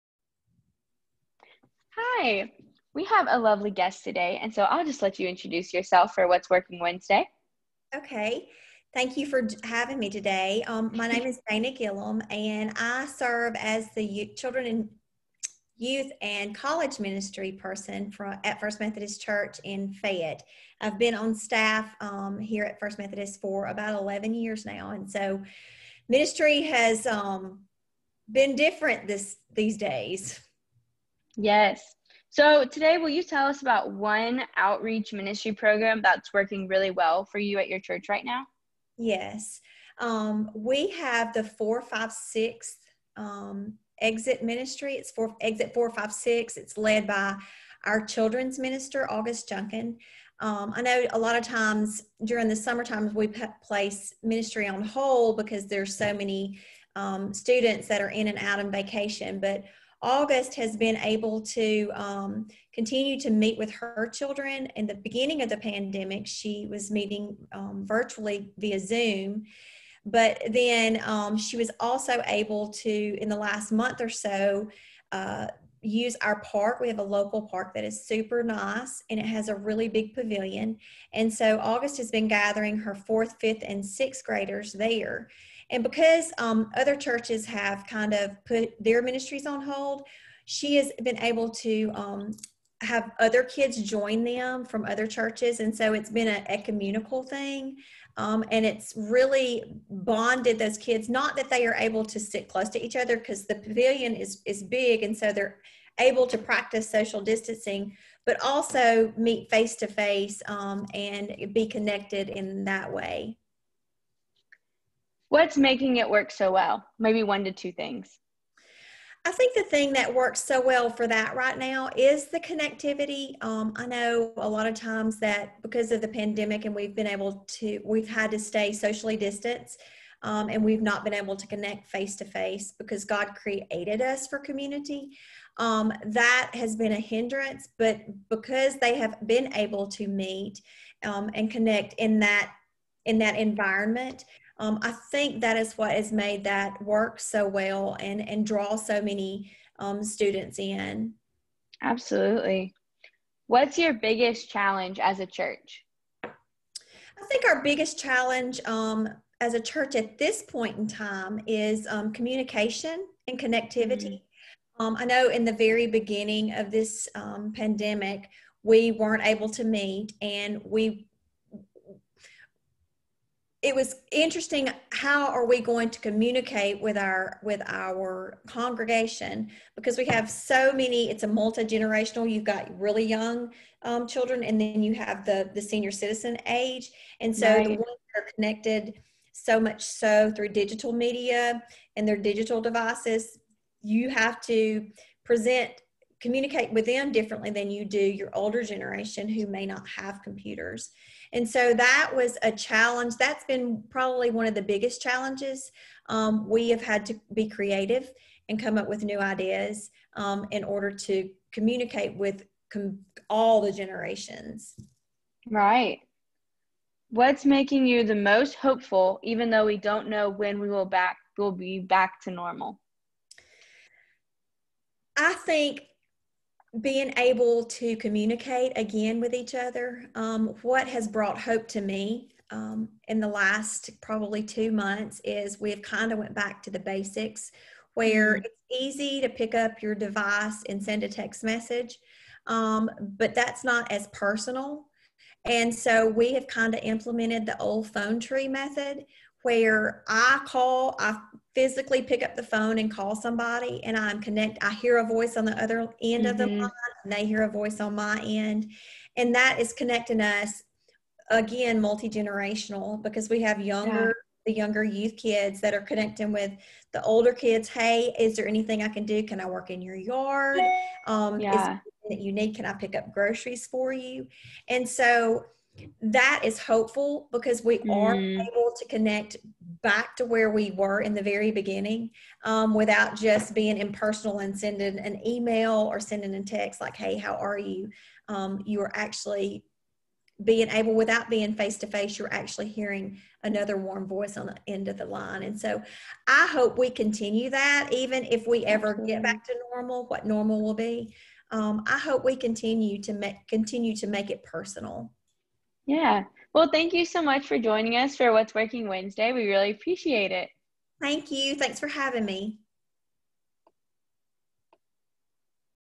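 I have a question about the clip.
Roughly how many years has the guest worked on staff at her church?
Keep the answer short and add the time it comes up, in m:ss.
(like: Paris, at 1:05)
11 years, at 0:23.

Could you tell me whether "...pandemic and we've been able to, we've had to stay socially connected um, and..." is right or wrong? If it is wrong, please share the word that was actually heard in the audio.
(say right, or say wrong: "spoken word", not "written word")
wrong: "distanced", not "connected".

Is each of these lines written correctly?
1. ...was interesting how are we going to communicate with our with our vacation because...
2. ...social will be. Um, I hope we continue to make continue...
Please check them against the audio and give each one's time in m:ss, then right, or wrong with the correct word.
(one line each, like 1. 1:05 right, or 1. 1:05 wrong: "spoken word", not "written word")
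1. 2:53 wrong: "congregation", not "vacation"
2. 5:00 wrong: "normal", not "social".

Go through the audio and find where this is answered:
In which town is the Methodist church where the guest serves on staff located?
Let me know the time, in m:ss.
0:19.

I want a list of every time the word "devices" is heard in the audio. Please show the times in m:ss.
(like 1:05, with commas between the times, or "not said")
3:12, 3:59.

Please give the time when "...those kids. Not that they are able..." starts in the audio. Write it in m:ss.
1:40.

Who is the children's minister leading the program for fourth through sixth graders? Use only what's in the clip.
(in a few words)
August Junkin.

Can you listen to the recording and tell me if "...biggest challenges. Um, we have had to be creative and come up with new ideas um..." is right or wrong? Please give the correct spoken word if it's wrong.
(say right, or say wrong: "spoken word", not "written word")
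right.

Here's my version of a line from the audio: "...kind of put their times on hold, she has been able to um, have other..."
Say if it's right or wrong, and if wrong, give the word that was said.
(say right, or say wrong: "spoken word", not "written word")
wrong: "ministries", not "times".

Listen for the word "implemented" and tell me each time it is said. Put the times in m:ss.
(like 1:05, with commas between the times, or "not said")
4:06.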